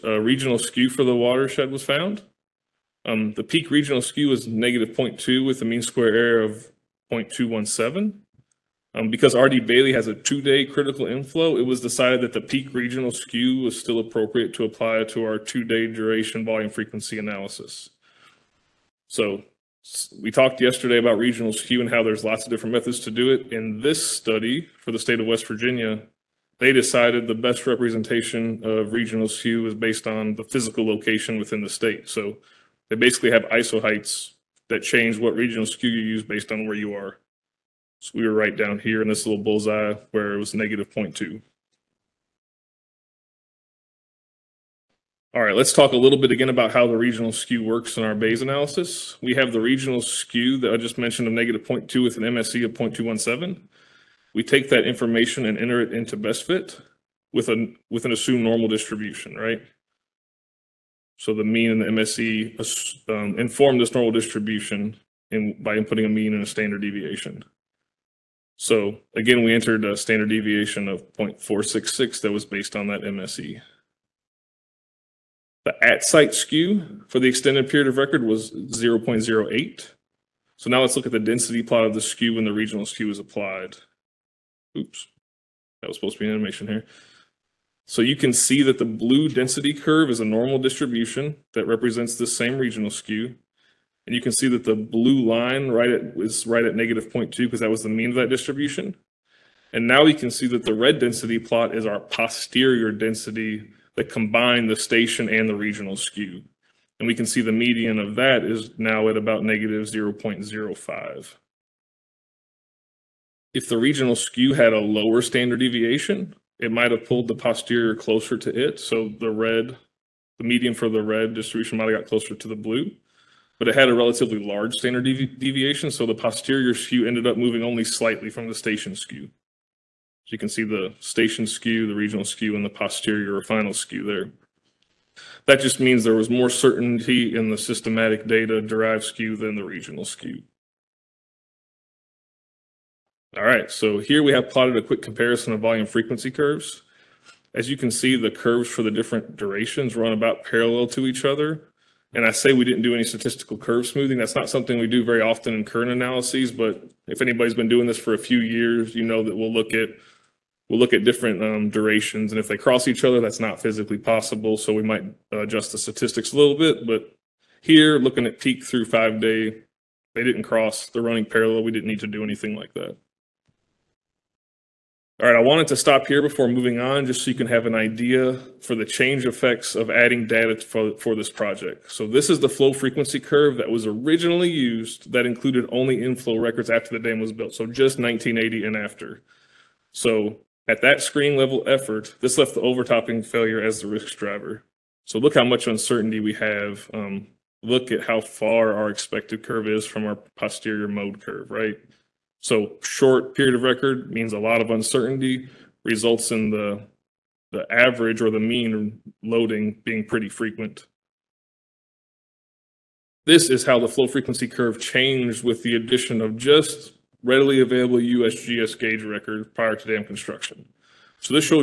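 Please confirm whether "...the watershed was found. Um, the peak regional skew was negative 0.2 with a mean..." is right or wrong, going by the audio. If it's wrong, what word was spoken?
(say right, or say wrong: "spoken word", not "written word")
right.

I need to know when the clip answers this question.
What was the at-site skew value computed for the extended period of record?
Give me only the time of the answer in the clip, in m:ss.
1:18.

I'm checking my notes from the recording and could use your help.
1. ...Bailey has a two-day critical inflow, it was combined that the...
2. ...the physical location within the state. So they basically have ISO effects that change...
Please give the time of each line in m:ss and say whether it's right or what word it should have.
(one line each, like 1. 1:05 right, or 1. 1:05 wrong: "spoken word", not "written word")
1. 0:09 wrong: "decided", not "combined"
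2. 0:30 wrong: "heights", not "effects".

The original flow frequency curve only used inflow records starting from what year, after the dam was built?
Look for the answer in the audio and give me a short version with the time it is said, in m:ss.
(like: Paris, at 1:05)
1980, at 3:07.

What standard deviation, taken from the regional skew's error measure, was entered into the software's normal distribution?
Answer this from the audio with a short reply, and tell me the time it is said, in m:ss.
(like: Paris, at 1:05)
0.466, at 1:11.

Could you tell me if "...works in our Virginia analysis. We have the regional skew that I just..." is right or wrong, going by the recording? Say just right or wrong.
wrong.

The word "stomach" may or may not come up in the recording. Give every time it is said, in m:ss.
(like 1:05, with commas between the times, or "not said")
not said.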